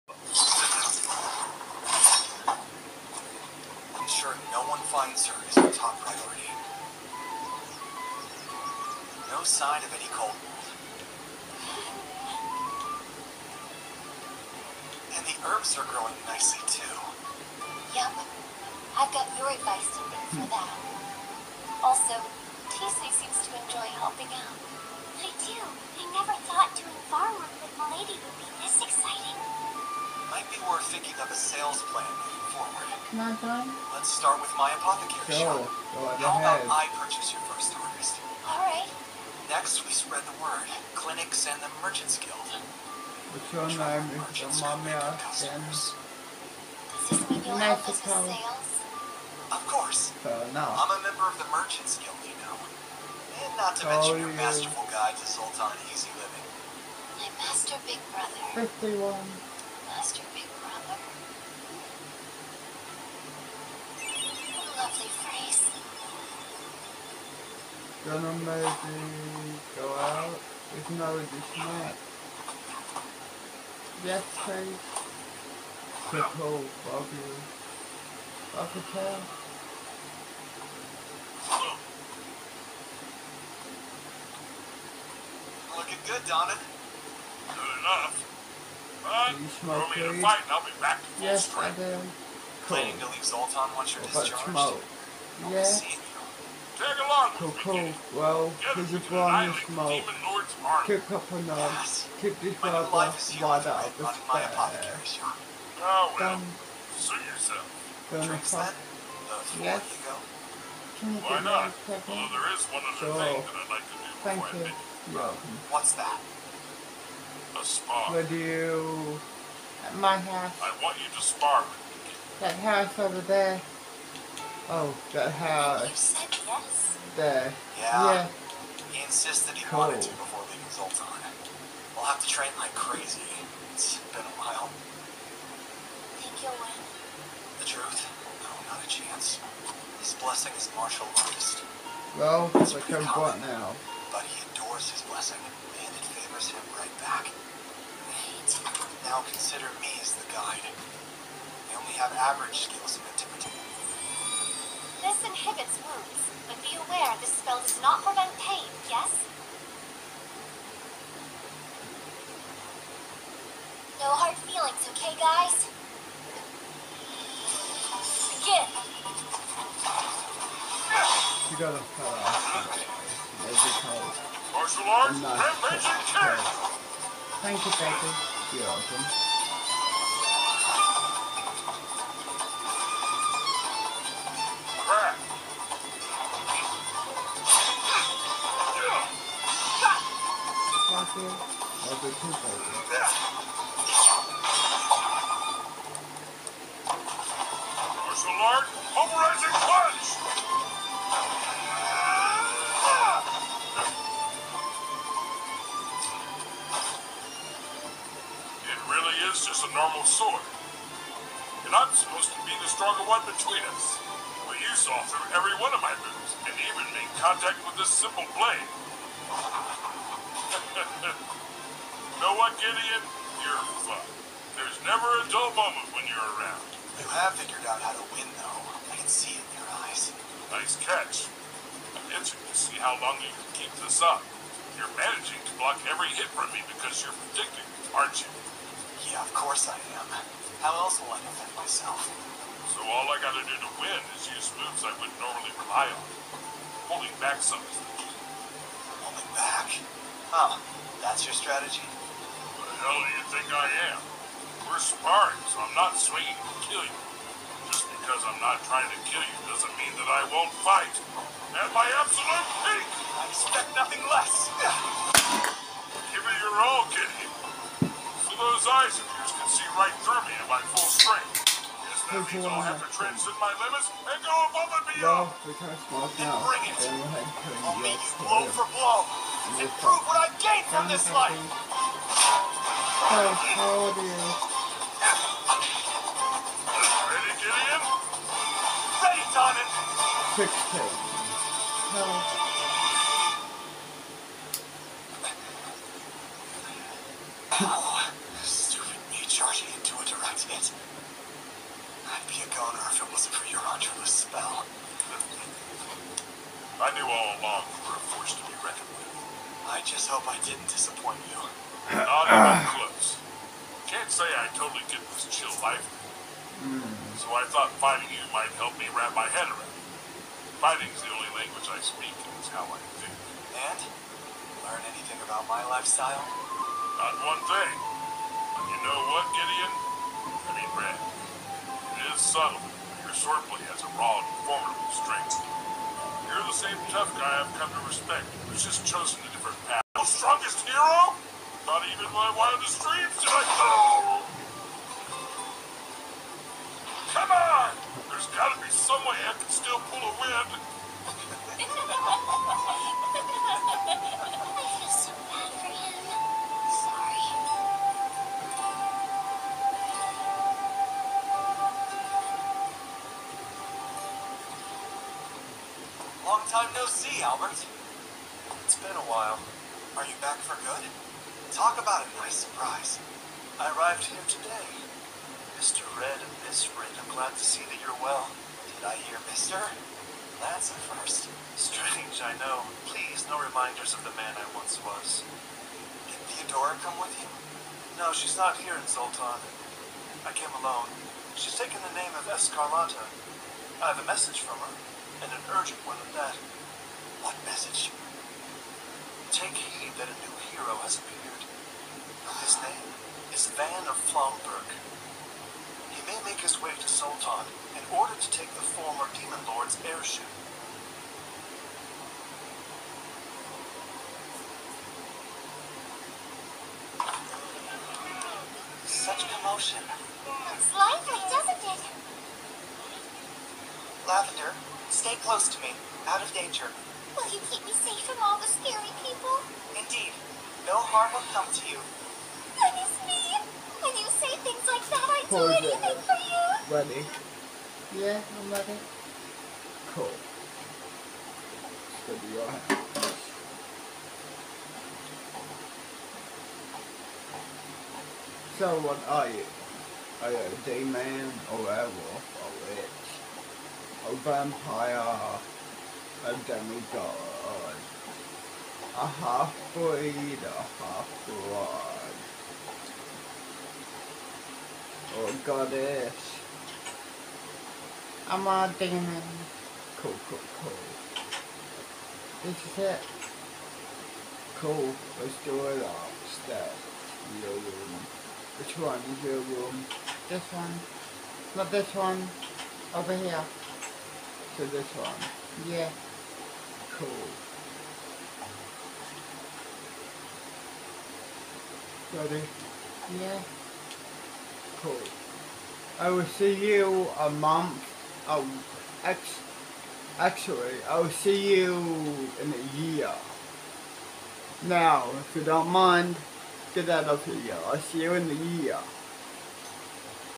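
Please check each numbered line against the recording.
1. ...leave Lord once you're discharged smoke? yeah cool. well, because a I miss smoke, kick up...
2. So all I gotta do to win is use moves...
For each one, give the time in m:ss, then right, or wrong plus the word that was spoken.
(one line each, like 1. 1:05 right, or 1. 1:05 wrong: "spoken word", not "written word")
1. 1:33 wrong: "Zoltan", not "Lord"
2. 4:02 right.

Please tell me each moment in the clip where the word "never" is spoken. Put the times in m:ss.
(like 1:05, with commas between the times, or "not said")
0:26, 3:44.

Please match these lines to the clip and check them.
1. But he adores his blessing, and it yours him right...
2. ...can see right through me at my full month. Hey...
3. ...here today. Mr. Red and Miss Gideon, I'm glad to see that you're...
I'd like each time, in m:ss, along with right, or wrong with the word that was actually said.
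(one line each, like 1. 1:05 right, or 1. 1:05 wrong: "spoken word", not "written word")
1. 2:24 wrong: "favors", not "yours"
2. 4:29 wrong: "strength", not "month"
3. 6:14 wrong: "Red", not "Gideon".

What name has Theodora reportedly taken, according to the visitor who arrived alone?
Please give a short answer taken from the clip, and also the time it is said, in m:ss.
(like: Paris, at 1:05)
Escarlata, at 6:32.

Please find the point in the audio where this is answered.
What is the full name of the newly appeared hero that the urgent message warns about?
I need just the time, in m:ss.
6:43.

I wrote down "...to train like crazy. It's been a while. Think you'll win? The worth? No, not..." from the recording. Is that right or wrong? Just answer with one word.
wrong.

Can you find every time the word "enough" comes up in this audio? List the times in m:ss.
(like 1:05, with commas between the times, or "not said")
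1:27.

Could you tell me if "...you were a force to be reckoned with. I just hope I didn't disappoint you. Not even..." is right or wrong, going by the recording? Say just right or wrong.
right.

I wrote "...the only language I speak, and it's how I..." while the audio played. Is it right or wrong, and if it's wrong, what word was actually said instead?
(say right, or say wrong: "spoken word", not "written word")
right.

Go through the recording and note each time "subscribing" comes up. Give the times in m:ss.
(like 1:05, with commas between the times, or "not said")
not said.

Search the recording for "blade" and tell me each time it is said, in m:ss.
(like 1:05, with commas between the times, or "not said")
3:38.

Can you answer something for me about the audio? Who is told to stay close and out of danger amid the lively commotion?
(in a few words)
Lavender.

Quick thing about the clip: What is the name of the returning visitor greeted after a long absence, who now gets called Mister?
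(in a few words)
Albert.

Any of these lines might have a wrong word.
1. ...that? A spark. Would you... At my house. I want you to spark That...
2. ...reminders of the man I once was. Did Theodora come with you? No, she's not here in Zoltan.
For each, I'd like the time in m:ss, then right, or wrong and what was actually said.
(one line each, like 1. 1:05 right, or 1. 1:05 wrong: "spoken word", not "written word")
1. 1:55 right
2. 6:23 right.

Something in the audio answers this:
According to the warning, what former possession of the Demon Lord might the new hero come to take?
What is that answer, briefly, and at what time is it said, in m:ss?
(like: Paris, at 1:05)
Airship, at 6:49.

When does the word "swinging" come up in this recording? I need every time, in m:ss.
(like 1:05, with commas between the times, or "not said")
4:15.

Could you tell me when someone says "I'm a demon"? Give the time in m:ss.
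7:48.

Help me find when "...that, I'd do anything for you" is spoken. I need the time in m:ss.
7:14.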